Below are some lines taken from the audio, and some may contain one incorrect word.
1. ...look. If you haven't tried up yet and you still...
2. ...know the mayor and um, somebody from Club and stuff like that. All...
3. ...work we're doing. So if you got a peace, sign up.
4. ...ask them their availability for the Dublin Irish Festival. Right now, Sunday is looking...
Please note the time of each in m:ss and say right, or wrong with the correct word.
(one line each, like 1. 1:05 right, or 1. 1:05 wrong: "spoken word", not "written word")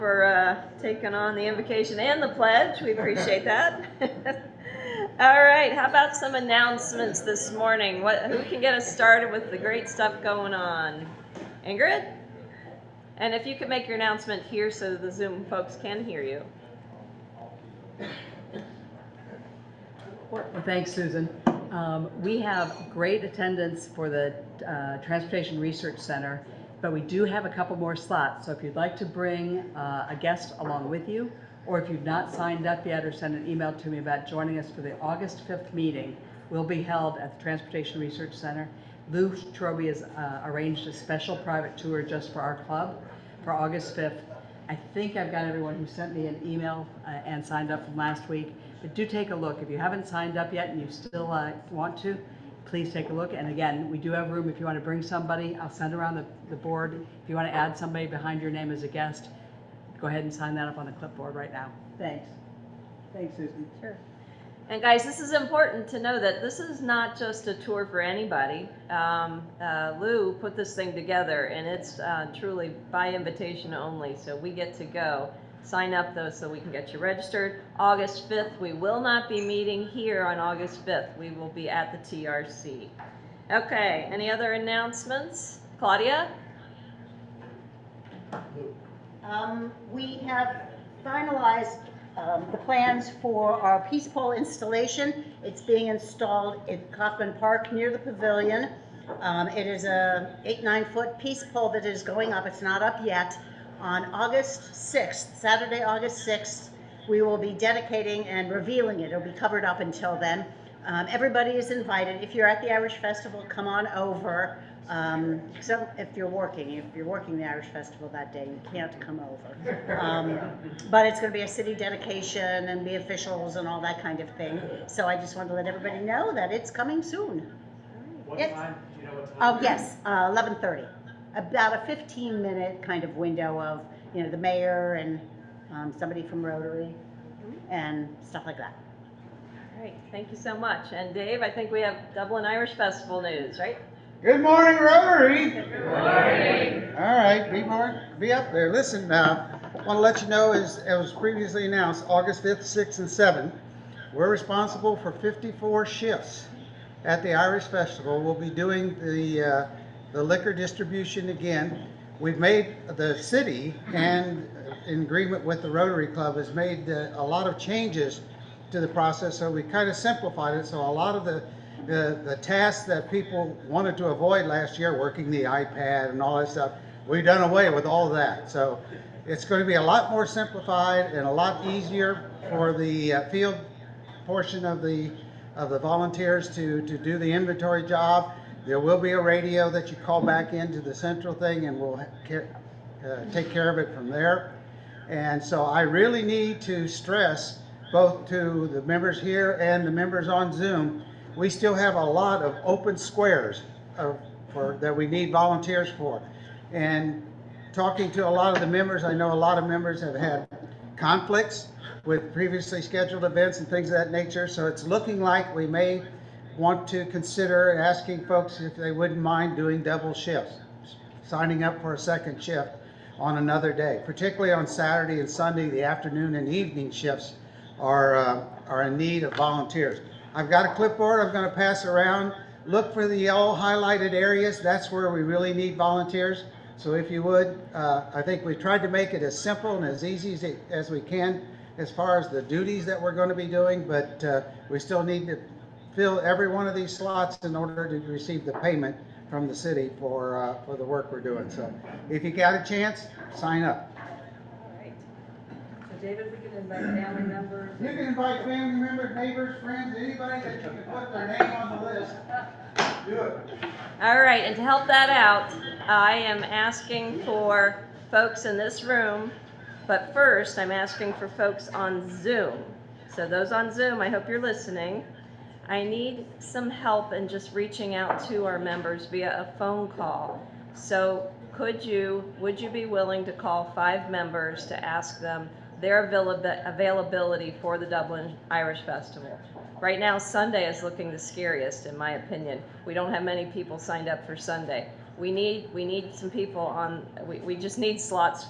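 1. 0:49 wrong: "signed", not "tried"
2. 2:14 wrong: "Rotary", not "Club"
3. 4:10 wrong: "chance", not "peace"
4. 4:44 right.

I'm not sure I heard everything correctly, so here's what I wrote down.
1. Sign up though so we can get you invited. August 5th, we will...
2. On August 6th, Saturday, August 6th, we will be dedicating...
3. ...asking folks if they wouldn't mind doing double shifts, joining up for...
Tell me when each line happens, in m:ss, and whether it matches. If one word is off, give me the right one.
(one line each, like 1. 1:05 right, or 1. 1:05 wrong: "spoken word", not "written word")
1. 1:15 wrong: "registered", not "invited"
2. 1:43 right
3. 3:37 wrong: "signing", not "joining".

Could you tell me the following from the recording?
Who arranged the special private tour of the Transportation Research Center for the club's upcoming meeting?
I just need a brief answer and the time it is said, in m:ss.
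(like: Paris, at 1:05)
Lou Troby, at 0:39.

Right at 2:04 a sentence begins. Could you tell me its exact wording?
So I just wanted to let everybody know that it's coming soon.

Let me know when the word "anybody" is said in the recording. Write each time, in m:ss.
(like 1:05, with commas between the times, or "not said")
1:07, 4:19.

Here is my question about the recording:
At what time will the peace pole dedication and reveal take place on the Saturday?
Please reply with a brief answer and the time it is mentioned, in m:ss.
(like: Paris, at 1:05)
11:30, at 2:10.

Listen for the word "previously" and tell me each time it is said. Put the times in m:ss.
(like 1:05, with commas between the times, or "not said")
2:31, 3:32.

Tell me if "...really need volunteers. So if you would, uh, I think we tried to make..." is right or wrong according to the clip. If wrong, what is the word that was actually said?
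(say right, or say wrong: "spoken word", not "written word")
right.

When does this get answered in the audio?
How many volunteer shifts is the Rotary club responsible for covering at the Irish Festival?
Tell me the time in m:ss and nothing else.
2:35.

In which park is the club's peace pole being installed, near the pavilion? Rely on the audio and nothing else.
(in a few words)
Coffman Park.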